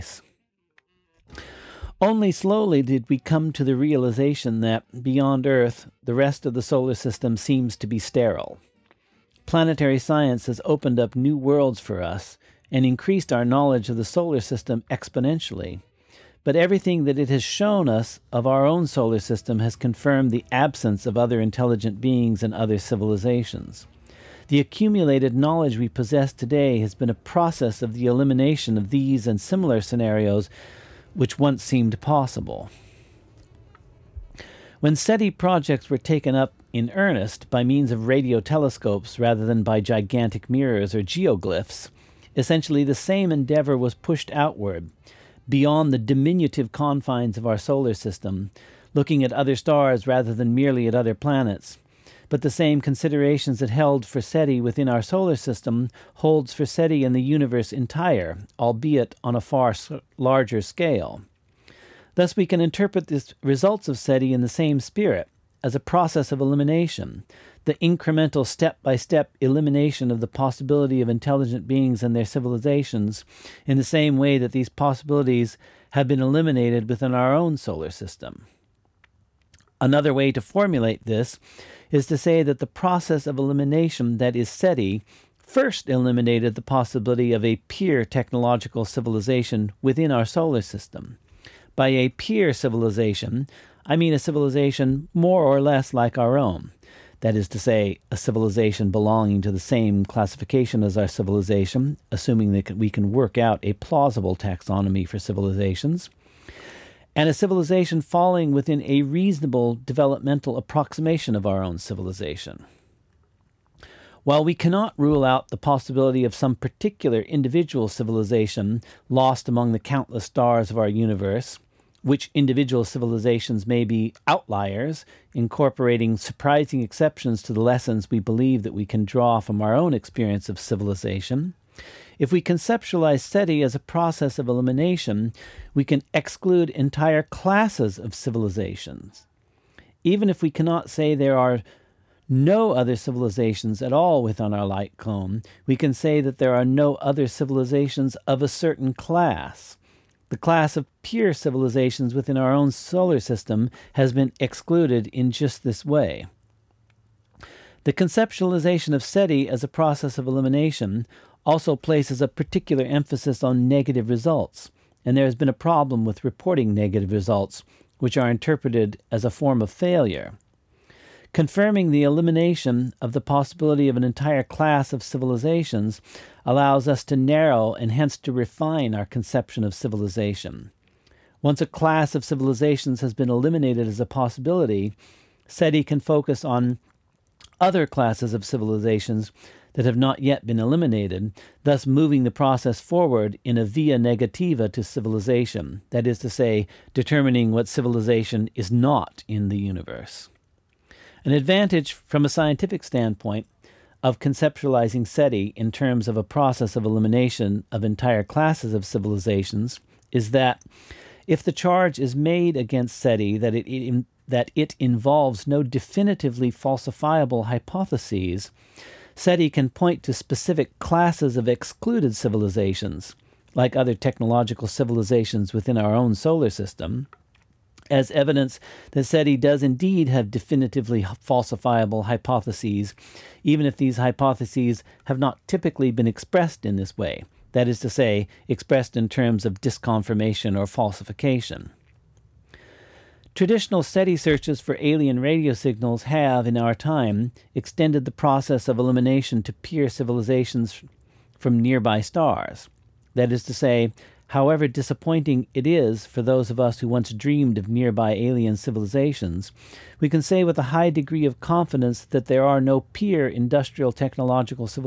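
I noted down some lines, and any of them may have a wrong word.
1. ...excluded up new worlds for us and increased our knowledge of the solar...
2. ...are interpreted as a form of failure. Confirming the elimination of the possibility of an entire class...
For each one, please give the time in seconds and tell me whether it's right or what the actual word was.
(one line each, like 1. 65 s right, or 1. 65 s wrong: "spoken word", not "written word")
1. 10 s wrong: "opened", not "excluded"
2. 168 s right.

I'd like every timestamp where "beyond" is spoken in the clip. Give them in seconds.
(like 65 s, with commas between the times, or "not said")
5 s, 45 s.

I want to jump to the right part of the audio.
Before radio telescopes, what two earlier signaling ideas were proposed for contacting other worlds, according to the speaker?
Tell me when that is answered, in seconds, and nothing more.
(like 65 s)
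39 s.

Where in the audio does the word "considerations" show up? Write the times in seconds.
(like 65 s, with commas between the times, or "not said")
52 s.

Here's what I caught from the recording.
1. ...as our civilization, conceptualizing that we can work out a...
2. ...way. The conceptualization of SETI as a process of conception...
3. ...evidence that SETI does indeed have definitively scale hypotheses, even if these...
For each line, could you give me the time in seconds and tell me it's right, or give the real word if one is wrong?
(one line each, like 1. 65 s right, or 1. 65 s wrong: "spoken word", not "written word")
1. 100 s wrong: "assuming", not "conceptualizing"
2. 155 s wrong: "elimination", not "conception"
3. 228 s wrong: "falsifiable", not "scale".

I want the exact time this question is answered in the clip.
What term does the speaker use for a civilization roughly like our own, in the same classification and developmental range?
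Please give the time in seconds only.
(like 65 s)
92 s.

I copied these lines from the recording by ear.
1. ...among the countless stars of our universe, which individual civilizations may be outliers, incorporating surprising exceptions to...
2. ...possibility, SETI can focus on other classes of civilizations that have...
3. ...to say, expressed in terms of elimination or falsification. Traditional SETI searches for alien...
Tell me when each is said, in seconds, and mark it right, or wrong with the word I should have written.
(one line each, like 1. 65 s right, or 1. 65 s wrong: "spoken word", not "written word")
1. 119 s right
2. 184 s right
3. 237 s wrong: "disconfirmation", not "elimination".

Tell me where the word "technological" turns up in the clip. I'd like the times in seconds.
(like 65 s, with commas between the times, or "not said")
88 s, 223 s, 263 s.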